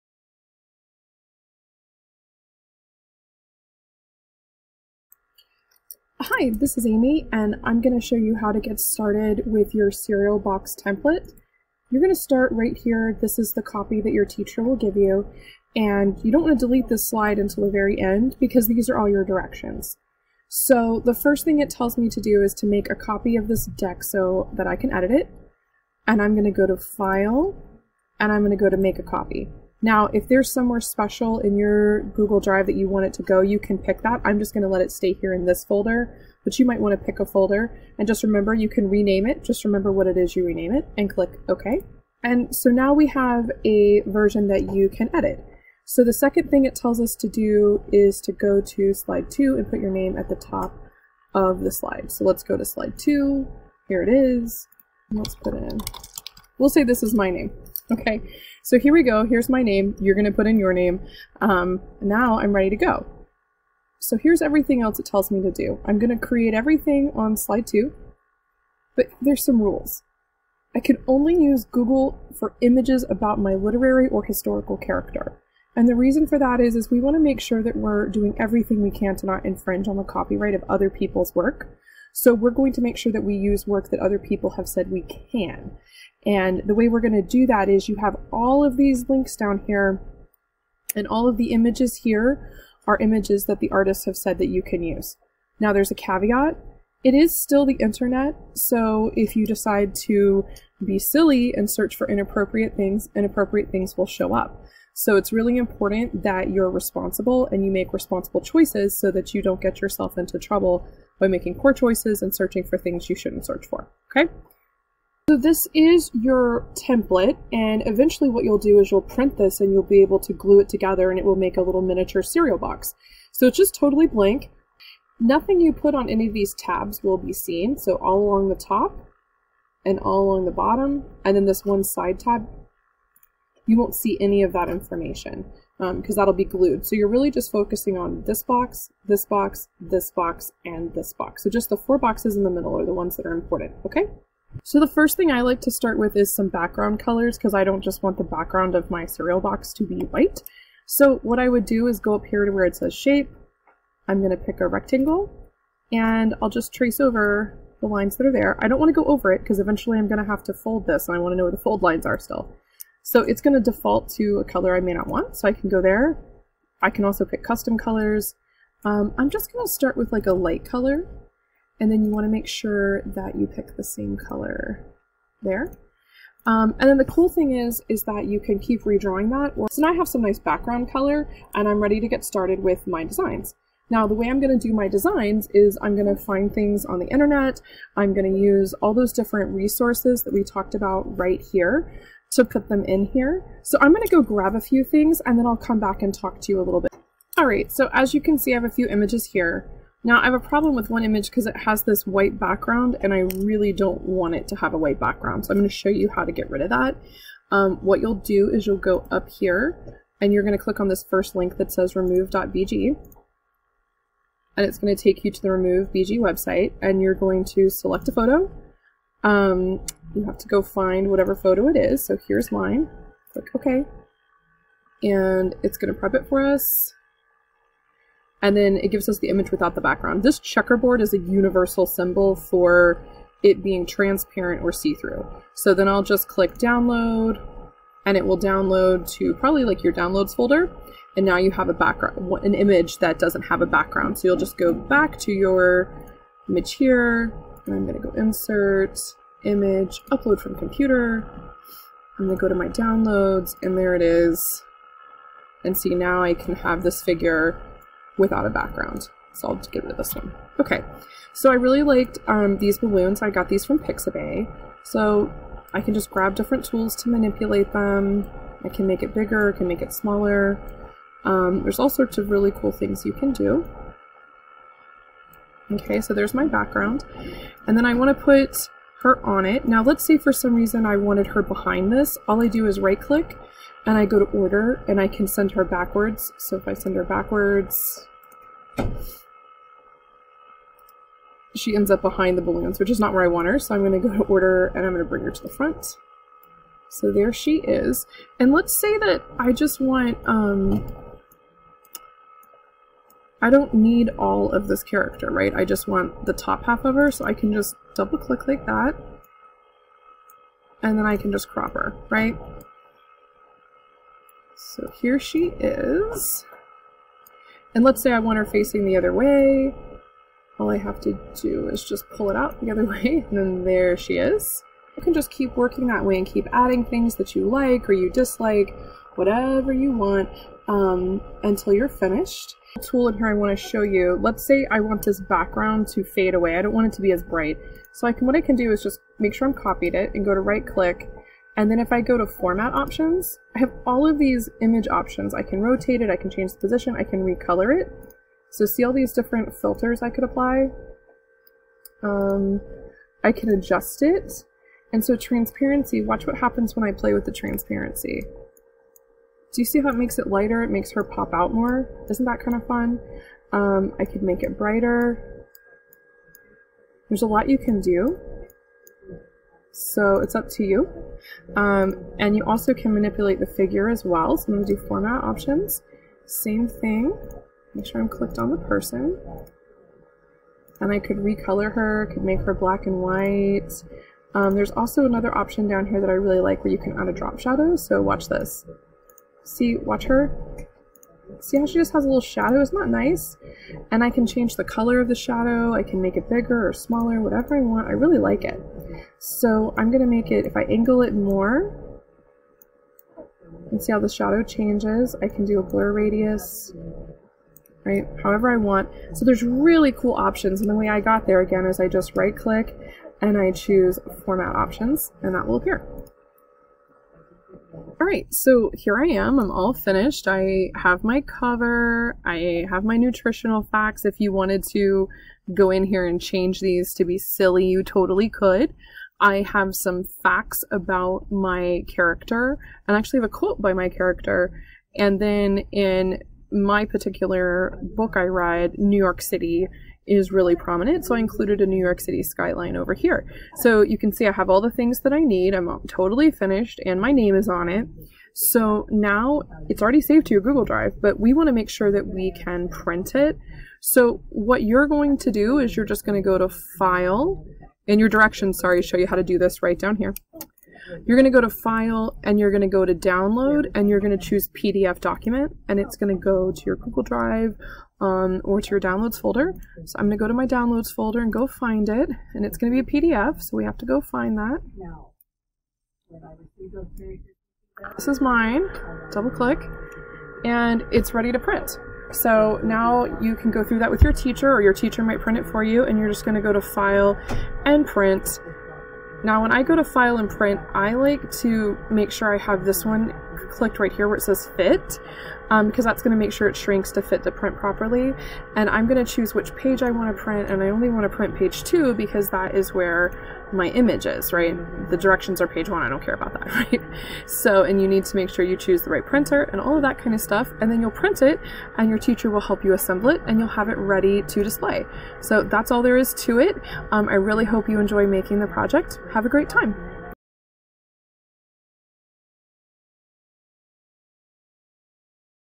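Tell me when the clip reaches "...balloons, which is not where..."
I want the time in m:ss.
4:52.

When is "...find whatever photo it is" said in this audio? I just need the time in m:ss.
3:40.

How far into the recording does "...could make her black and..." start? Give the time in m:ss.
6:22.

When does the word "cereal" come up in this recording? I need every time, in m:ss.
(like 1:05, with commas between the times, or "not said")
0:09, 2:02, 2:29.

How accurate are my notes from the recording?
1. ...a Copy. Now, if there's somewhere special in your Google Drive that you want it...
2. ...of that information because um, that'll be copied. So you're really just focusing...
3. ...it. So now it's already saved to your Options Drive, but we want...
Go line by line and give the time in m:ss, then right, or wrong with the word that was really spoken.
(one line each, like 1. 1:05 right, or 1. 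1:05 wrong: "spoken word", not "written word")
1. 0:28 right
2. 2:14 wrong: "glued", not "copied"
3. 7:27 wrong: "Google", not "Options".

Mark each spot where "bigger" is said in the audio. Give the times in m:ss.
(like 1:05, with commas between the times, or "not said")
4:29, 6:36.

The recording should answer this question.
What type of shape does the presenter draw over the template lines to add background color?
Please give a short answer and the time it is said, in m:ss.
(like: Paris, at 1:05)
rectangle, at 2:34.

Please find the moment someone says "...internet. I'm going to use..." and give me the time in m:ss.
3:07.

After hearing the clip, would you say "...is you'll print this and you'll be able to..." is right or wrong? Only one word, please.
right.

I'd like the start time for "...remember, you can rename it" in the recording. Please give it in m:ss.
0:38.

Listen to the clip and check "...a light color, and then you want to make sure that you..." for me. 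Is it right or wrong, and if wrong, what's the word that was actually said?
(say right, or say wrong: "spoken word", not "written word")
right.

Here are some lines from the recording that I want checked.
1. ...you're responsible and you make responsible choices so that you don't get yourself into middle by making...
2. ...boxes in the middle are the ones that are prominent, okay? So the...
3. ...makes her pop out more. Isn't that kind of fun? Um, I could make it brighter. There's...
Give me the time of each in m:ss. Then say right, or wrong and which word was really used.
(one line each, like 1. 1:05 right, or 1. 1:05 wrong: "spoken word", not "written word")
1. 1:46 wrong: "trouble", not "middle"
2. 2:21 wrong: "important", not "prominent"
3. 6:00 right.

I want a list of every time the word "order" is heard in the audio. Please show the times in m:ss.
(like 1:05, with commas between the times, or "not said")
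4:44, 4:54.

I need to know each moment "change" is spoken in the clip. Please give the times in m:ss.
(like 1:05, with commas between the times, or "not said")
5:46, 6:34, 6:44, 7:06.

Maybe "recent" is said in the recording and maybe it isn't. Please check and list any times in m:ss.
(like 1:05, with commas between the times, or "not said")
not said.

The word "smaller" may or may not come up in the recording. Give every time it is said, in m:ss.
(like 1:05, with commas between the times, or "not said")
4:29, 6:36.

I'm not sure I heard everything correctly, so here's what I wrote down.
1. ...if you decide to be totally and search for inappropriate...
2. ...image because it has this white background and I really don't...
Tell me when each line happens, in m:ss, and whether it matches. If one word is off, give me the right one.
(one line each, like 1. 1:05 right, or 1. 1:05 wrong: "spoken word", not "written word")
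1. 1:39 wrong: "silly", not "totally"
2. 3:21 right.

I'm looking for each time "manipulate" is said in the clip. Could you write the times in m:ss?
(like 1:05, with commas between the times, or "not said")
4:27, 6:12.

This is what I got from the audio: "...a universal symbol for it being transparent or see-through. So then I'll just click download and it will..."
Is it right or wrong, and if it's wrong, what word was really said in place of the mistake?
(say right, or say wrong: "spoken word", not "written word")
right.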